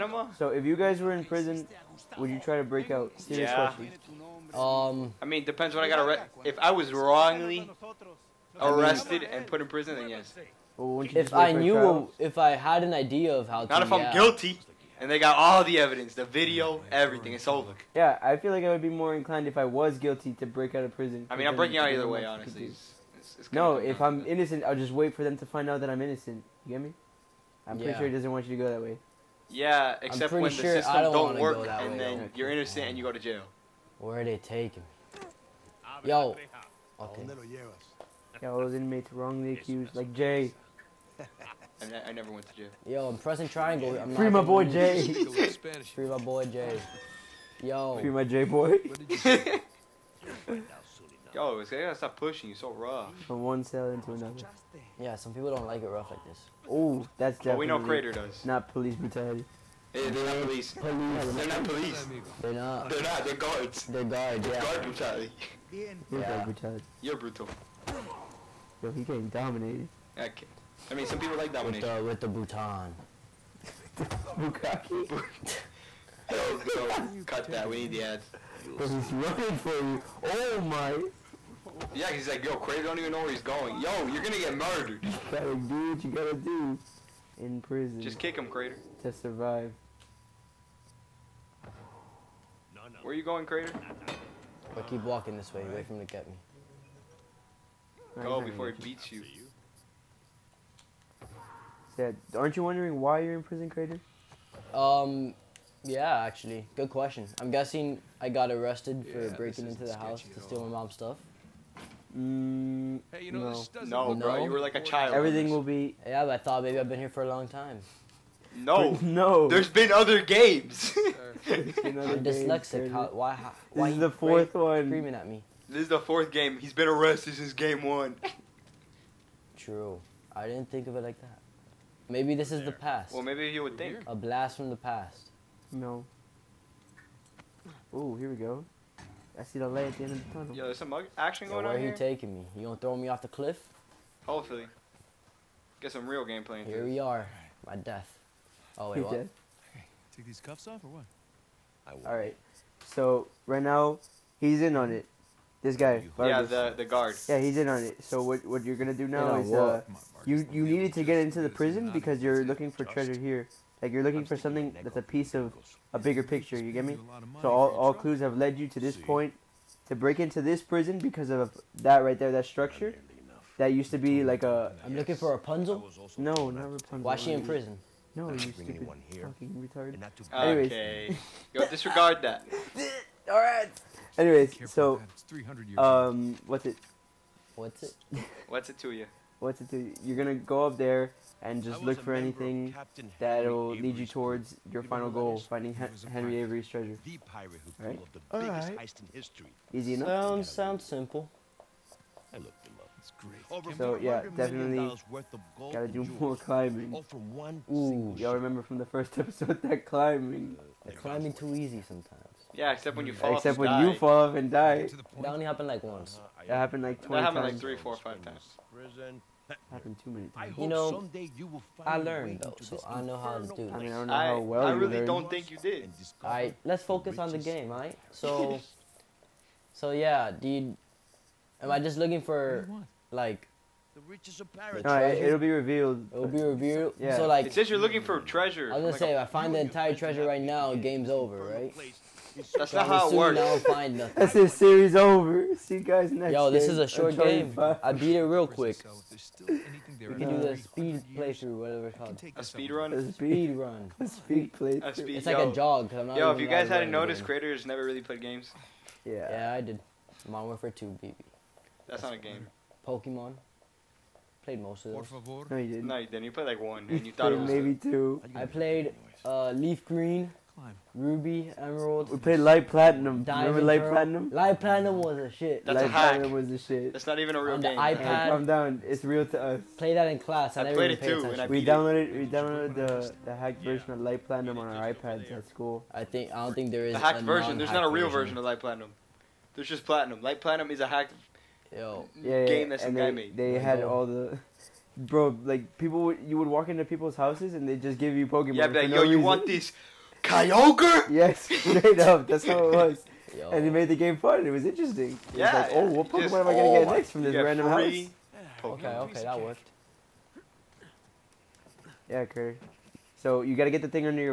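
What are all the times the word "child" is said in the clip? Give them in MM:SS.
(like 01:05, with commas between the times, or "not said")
01:54.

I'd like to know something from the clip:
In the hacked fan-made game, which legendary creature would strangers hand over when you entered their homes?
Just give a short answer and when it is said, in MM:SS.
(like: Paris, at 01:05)
Kyogre, at 05:00.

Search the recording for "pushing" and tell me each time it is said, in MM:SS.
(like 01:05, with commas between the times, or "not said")
00:52.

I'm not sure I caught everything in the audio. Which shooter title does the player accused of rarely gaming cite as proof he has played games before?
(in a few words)
Modern Warfare 2.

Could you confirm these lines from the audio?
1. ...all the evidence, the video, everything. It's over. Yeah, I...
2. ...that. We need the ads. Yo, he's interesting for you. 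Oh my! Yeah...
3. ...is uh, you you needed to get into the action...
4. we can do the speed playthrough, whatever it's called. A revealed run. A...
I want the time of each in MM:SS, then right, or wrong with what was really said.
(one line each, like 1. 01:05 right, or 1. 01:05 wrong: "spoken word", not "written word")
1. 00:15 right
2. 01:17 wrong: "running", not "interesting"
3. 02:39 wrong: "prison", not "action"
4. 04:09 wrong: "speed", not "revealed".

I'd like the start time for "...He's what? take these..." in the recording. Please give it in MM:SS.
02:29.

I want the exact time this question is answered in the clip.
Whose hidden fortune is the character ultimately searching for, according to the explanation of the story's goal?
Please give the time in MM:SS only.
03:16.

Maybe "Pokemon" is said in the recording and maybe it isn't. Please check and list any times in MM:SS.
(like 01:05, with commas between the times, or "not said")
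04:22, 04:58, 05:06.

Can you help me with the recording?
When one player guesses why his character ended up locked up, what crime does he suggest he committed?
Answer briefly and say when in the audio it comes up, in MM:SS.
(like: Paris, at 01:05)
Breaking into the house, at 01:49.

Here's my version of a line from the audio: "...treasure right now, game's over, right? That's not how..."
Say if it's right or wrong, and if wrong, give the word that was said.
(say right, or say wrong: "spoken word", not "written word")
right.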